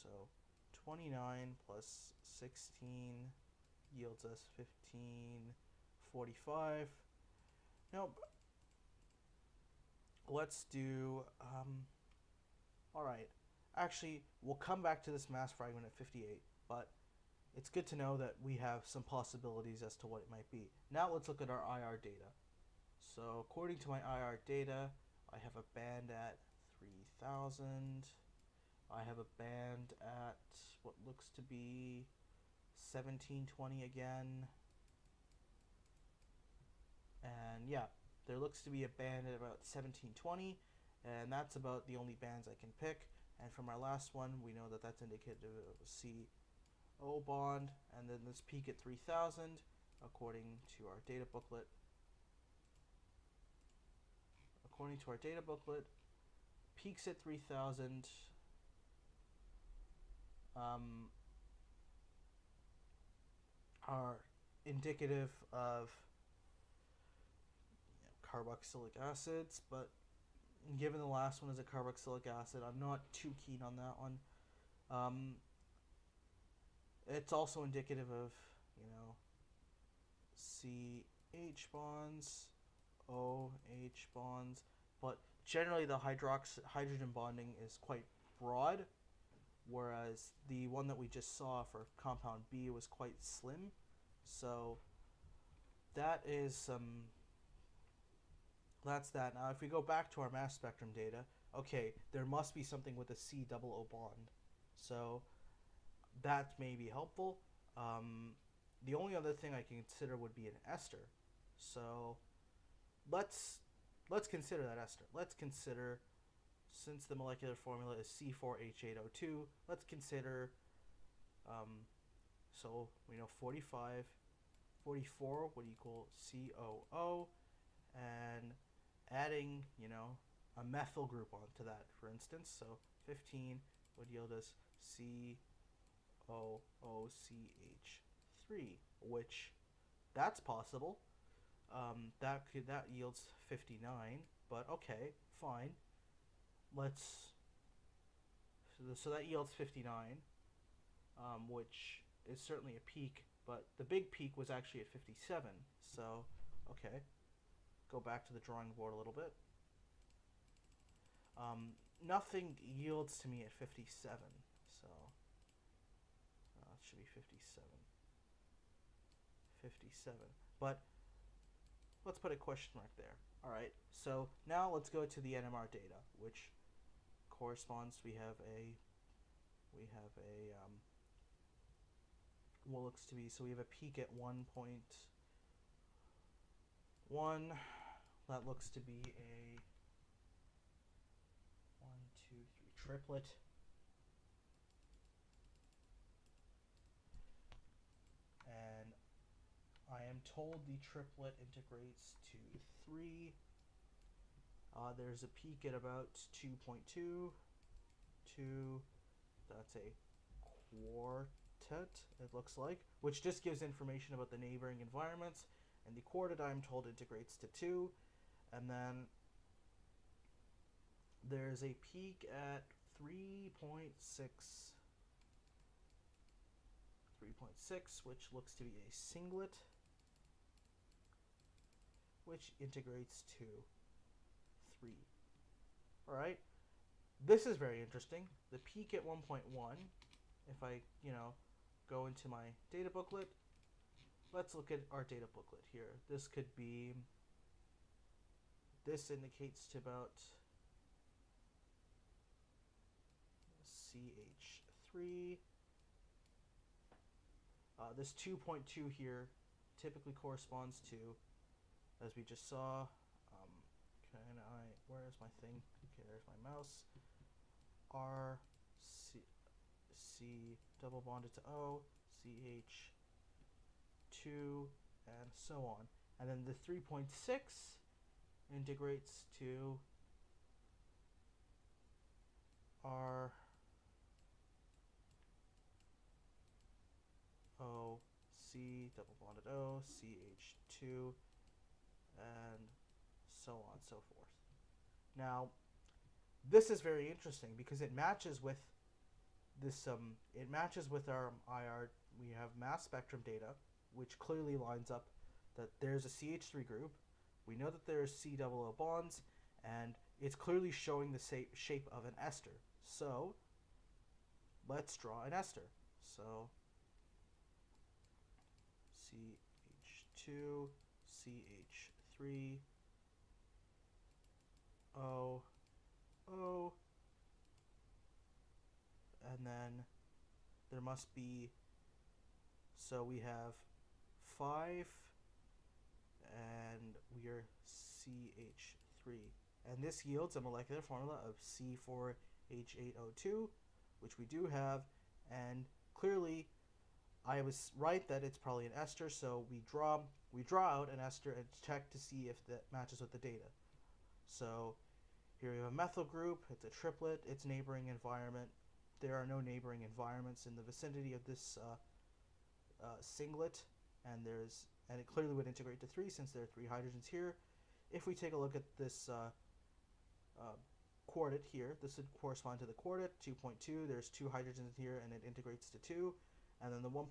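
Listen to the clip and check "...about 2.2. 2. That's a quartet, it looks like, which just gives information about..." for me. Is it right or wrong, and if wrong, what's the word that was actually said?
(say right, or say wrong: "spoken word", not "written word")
right.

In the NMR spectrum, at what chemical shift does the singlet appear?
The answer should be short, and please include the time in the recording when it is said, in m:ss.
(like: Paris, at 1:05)
3.6, at 3:47.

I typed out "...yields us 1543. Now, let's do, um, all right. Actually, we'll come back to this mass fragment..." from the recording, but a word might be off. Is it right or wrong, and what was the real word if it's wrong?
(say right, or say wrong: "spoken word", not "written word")
wrong: "1545", not "1543".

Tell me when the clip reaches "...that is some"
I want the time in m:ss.
1:35.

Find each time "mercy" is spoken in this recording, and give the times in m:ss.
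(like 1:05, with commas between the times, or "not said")
not said.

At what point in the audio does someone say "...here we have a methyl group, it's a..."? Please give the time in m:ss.
5:55.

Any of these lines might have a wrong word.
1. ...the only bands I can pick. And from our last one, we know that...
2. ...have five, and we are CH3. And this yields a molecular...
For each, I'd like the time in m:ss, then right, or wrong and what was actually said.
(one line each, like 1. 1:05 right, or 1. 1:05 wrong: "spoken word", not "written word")
1. 0:41 right
2. 5:33 right.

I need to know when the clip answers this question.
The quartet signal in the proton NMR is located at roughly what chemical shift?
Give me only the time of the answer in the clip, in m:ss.
6:12.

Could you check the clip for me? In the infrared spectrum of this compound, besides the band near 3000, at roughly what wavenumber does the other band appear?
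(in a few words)
1720.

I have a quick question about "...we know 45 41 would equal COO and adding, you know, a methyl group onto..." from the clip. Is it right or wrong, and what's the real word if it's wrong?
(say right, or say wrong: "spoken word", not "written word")
wrong: "44", not "41".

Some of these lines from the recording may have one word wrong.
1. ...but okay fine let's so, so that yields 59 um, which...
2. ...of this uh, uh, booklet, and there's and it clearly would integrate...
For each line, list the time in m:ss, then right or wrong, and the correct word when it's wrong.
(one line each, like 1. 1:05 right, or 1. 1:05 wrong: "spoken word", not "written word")
1. 2:24 right
2. 6:01 wrong: "singlet", not "booklet".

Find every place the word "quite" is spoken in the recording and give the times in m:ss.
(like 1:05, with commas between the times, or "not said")
1:27, 1:32.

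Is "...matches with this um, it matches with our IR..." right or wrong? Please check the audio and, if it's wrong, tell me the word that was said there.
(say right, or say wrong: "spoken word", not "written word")
right.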